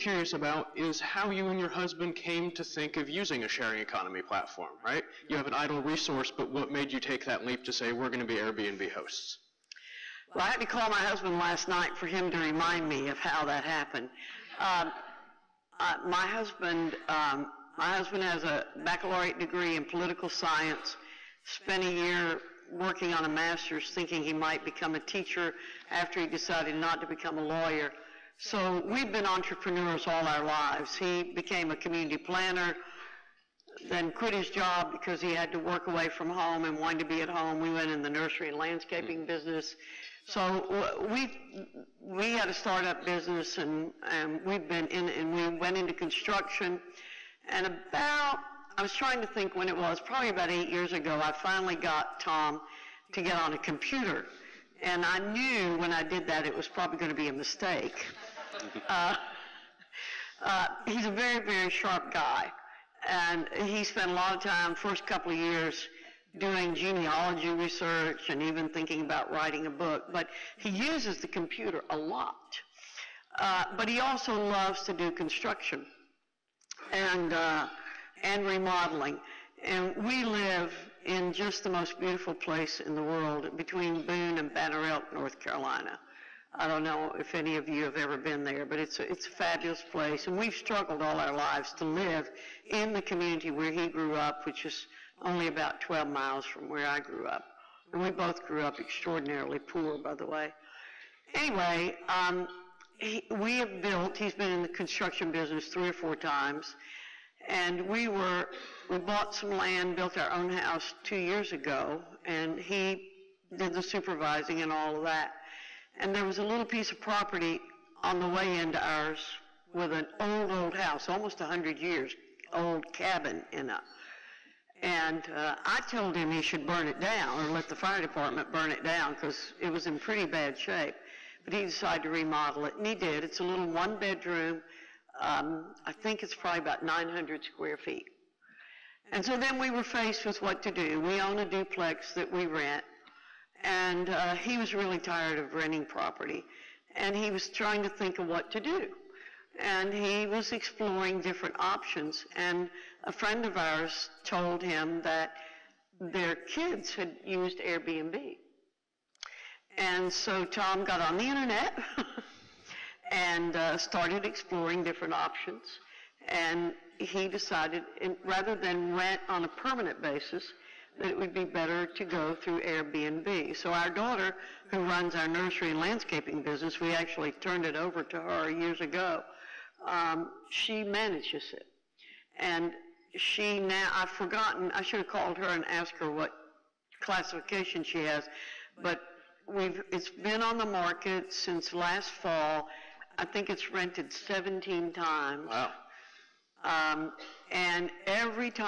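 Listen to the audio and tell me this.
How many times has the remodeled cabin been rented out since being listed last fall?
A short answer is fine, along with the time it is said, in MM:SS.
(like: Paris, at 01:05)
17, at 03:14.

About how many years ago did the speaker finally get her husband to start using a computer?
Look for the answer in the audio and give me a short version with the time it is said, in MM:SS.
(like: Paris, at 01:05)
8, at 00:50.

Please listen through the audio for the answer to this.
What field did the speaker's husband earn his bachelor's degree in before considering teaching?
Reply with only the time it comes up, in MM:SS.
00:19.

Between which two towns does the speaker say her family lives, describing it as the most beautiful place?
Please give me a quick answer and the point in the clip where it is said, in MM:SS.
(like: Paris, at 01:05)
Boone and Banner Elk, at 01:24.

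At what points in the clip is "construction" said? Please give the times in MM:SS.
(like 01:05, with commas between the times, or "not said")
00:45, 01:15, 01:44.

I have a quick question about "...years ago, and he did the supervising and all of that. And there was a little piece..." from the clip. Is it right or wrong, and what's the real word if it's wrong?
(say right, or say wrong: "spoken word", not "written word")
right.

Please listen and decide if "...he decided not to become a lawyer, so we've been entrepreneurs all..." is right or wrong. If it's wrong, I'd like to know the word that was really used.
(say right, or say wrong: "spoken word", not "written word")
right.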